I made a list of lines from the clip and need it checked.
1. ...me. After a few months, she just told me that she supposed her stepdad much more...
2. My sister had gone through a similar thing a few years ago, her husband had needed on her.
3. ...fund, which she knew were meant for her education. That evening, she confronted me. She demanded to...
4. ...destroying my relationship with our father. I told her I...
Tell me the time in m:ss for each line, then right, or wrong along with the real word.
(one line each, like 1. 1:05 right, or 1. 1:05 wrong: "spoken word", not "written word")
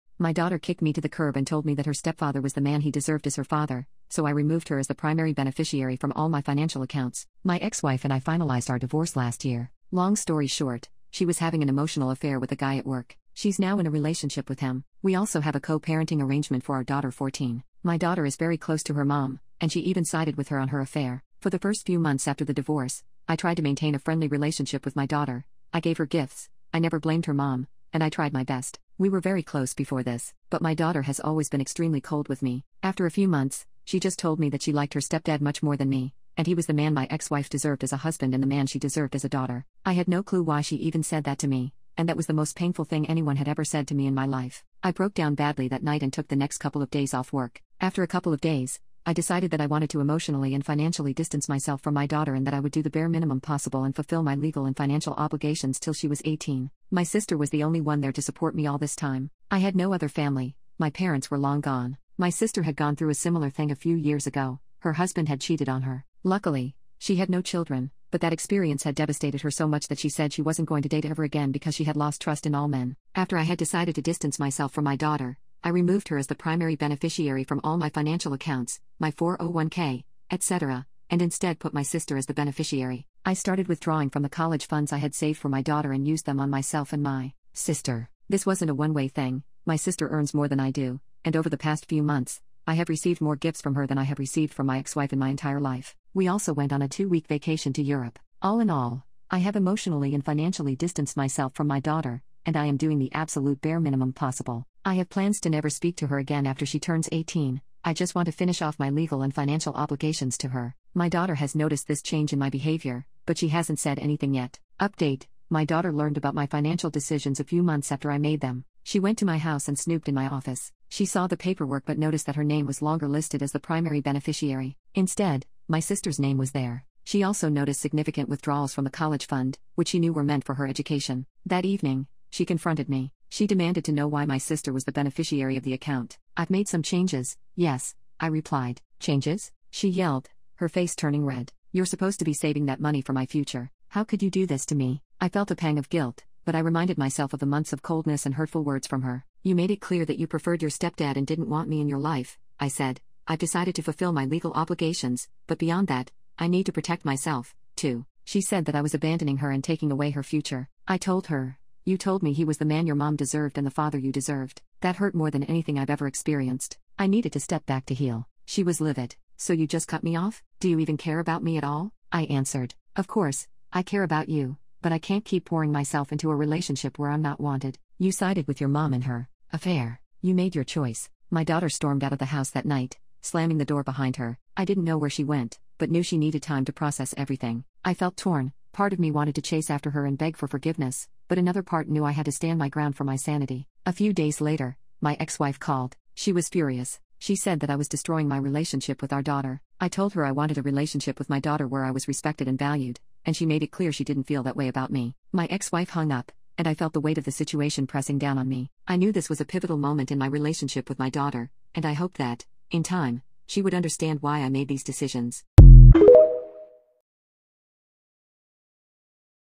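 1. 0:32 wrong: "liked", not "supposed"
2. 1:02 wrong: "cheated", not "needed"
3. 2:09 right
4. 3:17 wrong: "daughter", not "father".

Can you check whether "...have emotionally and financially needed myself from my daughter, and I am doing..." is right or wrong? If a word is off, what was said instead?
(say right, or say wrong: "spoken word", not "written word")
wrong: "distanced", not "needed".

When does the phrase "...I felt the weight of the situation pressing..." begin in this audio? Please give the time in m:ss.
3:26.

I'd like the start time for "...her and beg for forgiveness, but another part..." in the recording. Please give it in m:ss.
3:09.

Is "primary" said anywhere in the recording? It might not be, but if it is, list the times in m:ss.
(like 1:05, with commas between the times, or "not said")
0:04, 1:16, 2:03.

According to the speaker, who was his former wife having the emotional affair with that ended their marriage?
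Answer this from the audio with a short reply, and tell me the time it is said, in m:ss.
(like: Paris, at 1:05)
a guy at work, at 0:12.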